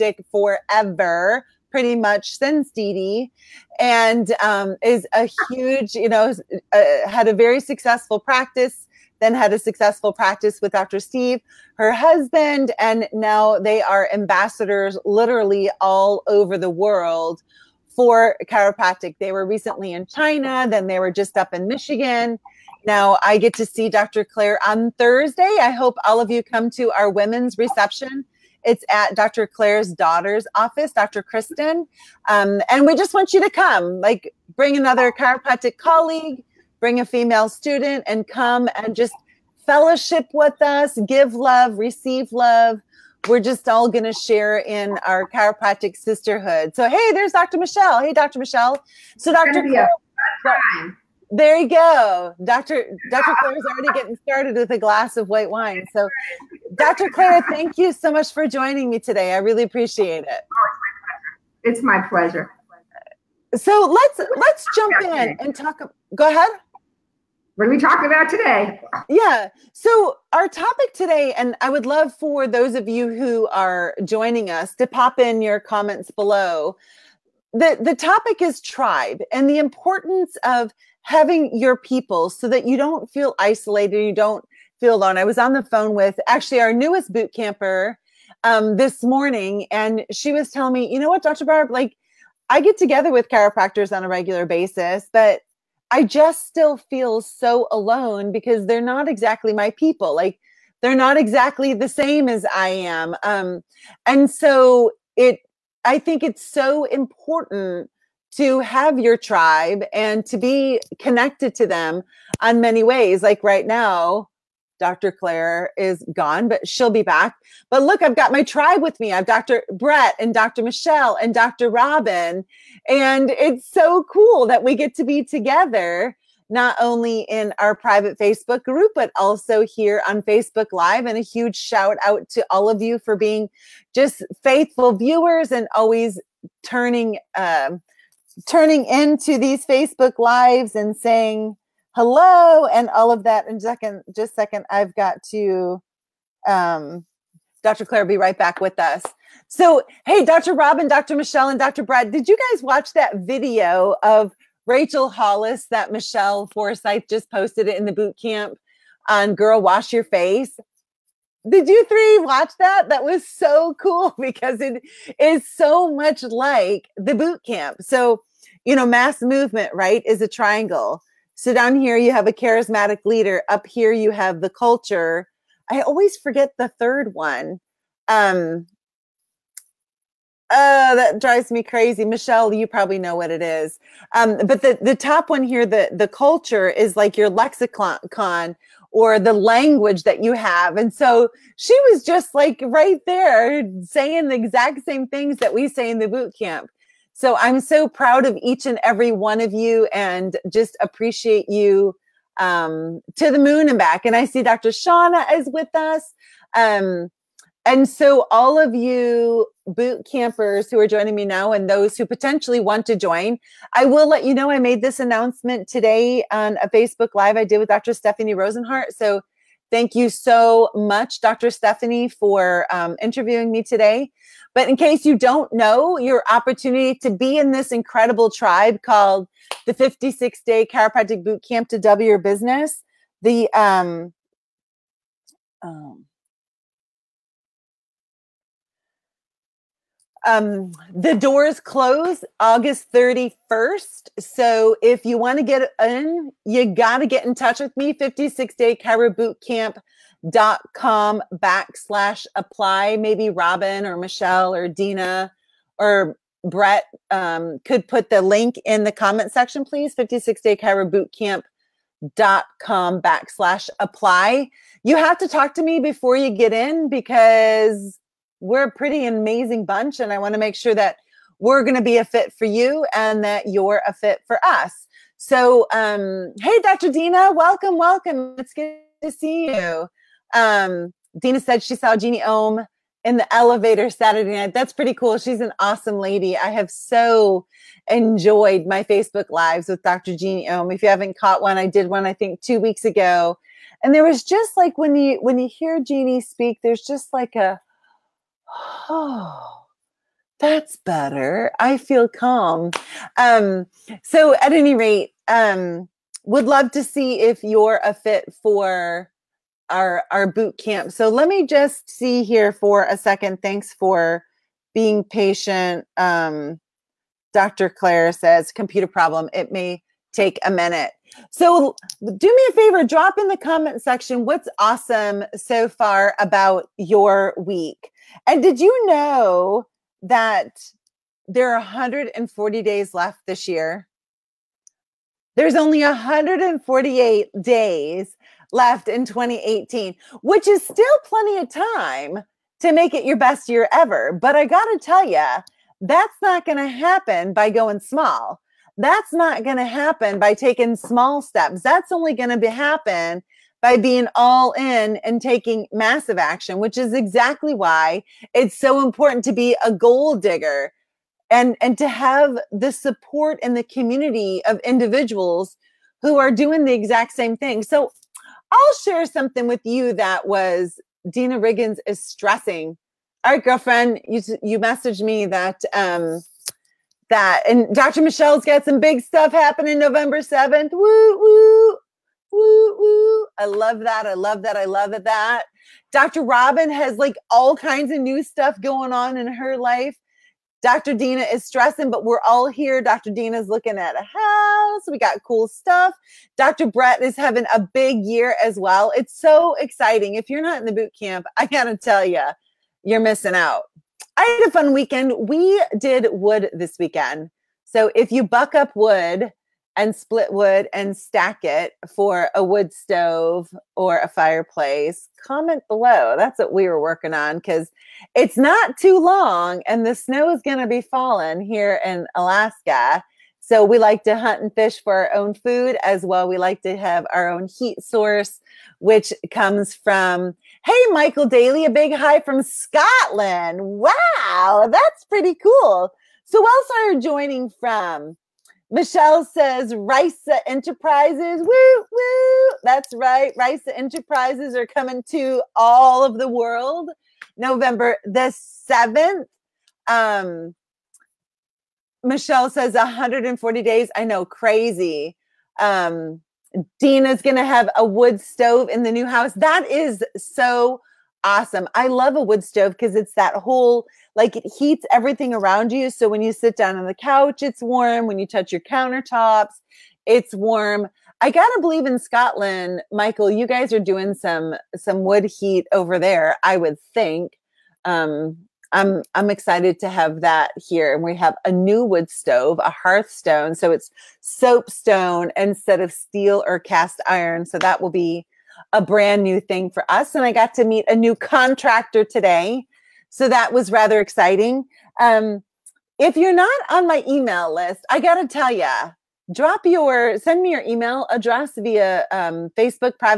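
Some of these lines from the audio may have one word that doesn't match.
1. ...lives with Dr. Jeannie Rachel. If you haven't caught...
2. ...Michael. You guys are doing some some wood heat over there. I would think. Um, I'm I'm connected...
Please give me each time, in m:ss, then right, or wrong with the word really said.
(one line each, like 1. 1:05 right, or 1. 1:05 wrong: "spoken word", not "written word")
1. 4:49 wrong: "Ohm", not "Rachel"
2. 7:52 wrong: "excited", not "connected".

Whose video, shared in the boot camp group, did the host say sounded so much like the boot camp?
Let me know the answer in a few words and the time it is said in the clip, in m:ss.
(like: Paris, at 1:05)
Rachel Hollis, at 2:34.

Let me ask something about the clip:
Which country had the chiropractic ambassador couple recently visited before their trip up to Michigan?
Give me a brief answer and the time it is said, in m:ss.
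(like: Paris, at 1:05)
China, at 0:20.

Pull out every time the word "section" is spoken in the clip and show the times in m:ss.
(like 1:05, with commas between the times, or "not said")
4:19, 5:23.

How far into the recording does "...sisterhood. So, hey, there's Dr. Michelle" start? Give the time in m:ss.
0:45.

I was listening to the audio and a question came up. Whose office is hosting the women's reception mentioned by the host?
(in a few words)
Dr. Kristen.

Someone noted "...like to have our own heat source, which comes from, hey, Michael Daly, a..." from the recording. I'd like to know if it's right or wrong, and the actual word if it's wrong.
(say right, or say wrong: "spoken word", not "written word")
right.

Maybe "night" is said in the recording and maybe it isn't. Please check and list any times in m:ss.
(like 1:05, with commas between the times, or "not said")
4:44.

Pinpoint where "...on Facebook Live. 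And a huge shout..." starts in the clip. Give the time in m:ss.
2:10.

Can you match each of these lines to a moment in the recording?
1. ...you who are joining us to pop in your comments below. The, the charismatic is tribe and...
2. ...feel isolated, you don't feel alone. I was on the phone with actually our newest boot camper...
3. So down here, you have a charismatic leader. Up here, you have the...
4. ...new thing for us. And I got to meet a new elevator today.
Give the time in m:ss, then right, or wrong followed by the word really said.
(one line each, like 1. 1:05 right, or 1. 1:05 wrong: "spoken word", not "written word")
1. 1:12 wrong: "topic", not "charismatic"
2. 1:23 right
3. 2:51 right
4. 8:09 wrong: "contractor", not "elevator".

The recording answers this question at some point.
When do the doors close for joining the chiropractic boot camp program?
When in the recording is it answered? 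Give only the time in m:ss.
4:02.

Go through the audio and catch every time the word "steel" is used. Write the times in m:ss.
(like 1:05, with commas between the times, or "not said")
8:05.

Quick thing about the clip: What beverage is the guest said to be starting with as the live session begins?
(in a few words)
white wine.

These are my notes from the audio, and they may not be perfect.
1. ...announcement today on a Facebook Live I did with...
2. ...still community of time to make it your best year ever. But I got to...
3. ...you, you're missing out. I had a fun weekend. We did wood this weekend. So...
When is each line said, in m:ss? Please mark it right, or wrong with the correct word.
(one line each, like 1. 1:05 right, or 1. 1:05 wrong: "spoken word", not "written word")
1. 3:35 right
2. 5:40 wrong: "plenty", not "community"
3. 6:42 right.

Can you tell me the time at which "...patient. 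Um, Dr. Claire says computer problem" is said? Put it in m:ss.
5:15.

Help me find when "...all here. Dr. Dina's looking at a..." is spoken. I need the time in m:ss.
6:32.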